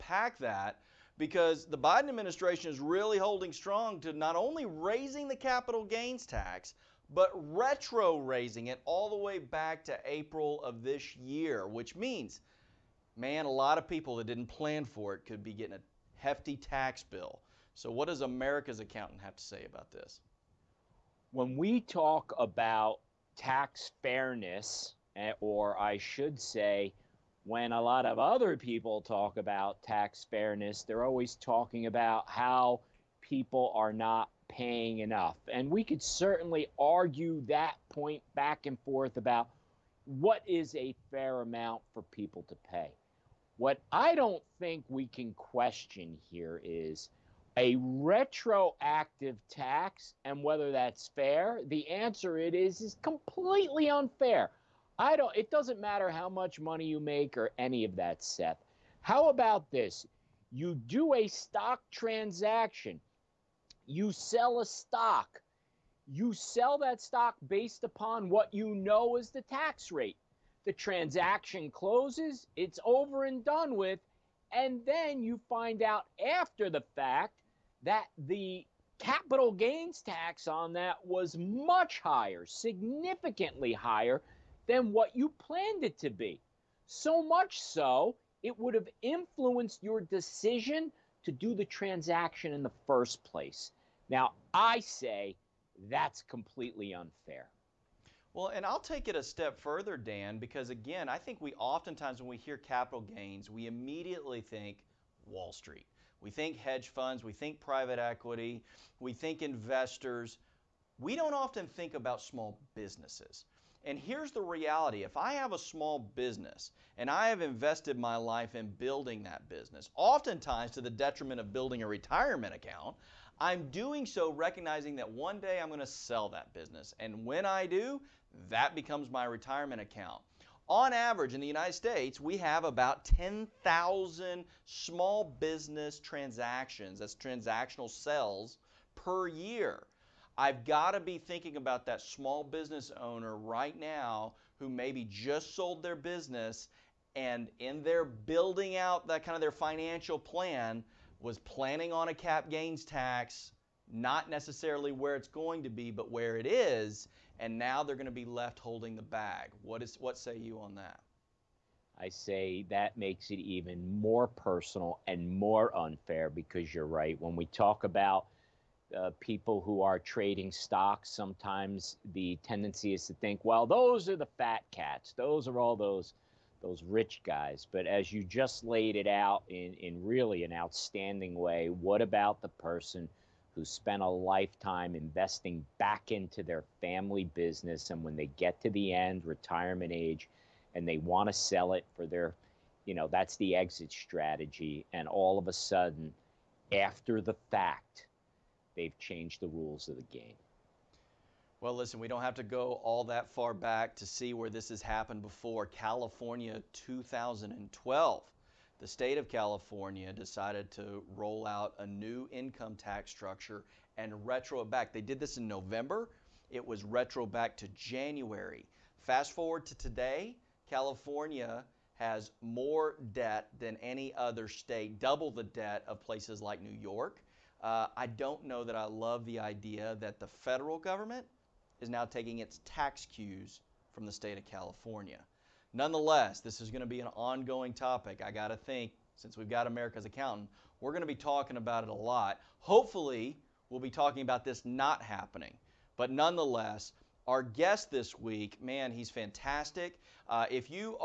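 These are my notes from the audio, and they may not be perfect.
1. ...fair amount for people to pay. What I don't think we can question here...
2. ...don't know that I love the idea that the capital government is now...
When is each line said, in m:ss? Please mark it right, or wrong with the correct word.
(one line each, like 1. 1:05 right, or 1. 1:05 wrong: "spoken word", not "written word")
1. 0:41 right
2. 3:48 wrong: "federal", not "capital".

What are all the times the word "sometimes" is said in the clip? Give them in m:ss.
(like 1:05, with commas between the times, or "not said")
2:51.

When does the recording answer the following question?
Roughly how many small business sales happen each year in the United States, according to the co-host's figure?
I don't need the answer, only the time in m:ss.
2:13.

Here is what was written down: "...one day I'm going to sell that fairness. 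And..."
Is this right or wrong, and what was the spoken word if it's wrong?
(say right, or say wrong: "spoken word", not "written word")
wrong: "business", not "fairness".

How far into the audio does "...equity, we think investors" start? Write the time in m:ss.
1:47.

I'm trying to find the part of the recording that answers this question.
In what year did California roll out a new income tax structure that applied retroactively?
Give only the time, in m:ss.
3:26.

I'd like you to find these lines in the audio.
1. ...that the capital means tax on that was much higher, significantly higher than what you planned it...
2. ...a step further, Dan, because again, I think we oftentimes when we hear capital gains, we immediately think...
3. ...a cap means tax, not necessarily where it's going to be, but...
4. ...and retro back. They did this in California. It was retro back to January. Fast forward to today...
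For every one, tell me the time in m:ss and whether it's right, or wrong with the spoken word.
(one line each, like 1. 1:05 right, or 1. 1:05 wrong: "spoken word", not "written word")
1. 1:17 wrong: "gains", not "means"
2. 1:39 right
3. 2:32 wrong: "gains", not "means"
4. 3:33 wrong: "November", not "California".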